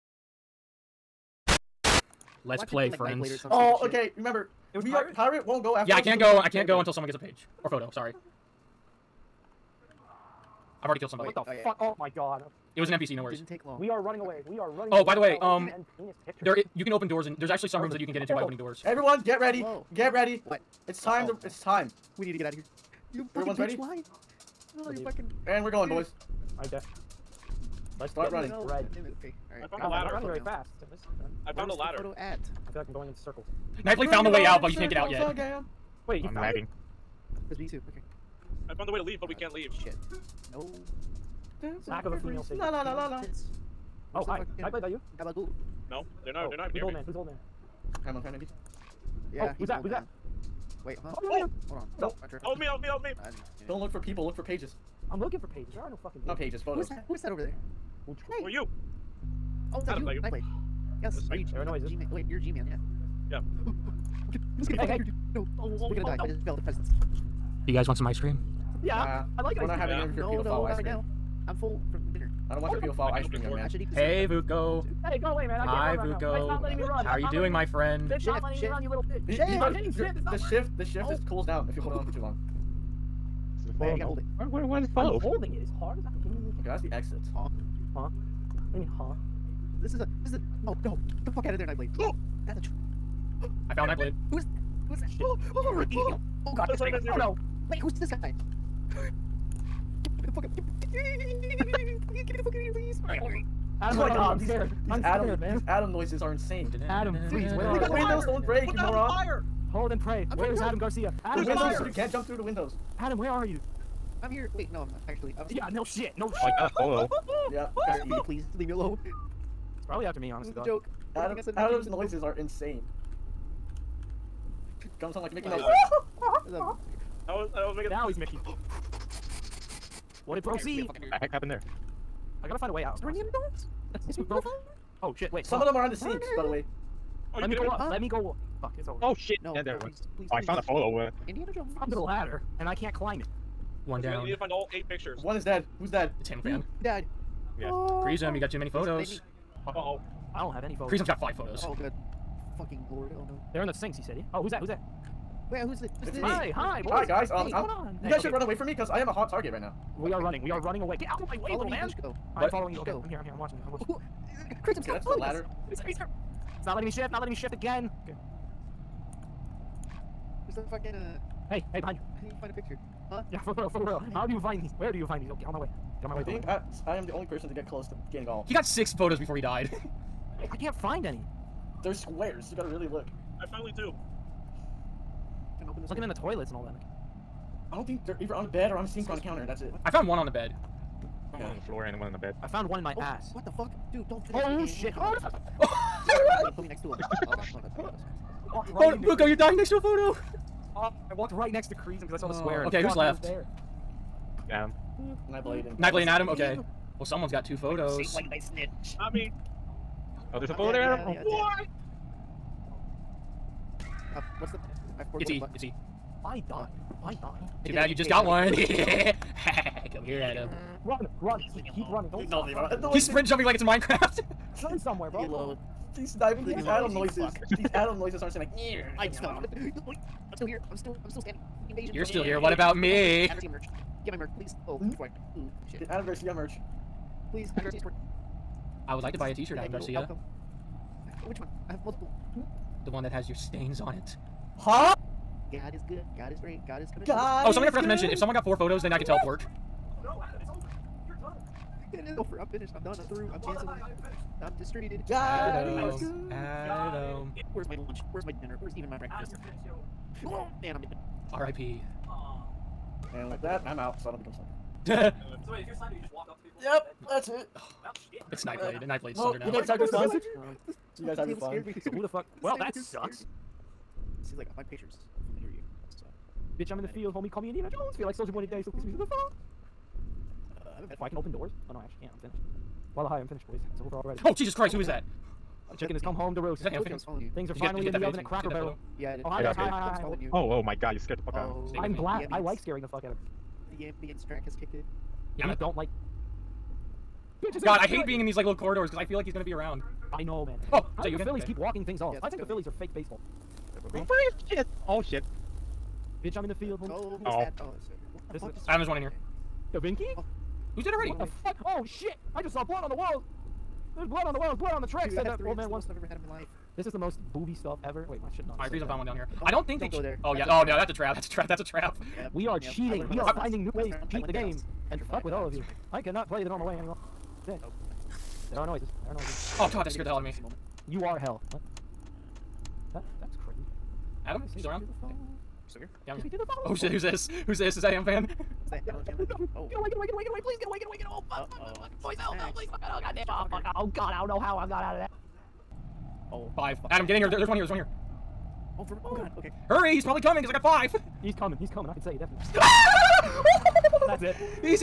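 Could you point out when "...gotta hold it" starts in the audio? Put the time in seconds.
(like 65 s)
83 s.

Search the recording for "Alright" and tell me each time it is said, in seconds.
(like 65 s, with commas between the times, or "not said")
29 s.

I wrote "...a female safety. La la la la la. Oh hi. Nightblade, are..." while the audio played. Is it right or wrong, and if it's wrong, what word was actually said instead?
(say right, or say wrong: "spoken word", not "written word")
right.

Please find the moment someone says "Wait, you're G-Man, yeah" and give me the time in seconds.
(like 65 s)
62 s.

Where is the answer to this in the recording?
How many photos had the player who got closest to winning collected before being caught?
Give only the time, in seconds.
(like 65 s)
178 s.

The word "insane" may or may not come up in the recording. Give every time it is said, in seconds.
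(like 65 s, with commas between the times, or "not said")
106 s, 122 s.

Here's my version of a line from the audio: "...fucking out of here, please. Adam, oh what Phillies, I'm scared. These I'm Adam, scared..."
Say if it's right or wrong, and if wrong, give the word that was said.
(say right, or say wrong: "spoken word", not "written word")
wrong: "God", not "Phillies".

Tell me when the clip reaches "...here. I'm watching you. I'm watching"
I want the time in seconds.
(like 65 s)
163 s.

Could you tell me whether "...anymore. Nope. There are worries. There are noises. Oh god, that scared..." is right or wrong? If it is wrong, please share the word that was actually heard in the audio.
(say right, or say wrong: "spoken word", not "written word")
wrong: "noises", not "worries".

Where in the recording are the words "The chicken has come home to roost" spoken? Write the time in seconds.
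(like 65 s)
285 s.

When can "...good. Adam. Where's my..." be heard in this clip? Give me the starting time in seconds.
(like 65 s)
255 s.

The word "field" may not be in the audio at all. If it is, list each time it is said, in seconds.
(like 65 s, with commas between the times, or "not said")
276 s, 306 s.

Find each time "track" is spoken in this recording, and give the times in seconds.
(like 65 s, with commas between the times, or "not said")
294 s, 314 s.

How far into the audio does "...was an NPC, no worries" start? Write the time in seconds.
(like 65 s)
12 s.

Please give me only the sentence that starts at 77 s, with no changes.
How are you doing, my friend?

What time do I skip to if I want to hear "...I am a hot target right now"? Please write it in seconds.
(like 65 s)
158 s.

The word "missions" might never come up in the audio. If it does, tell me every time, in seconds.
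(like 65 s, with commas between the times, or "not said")
not said.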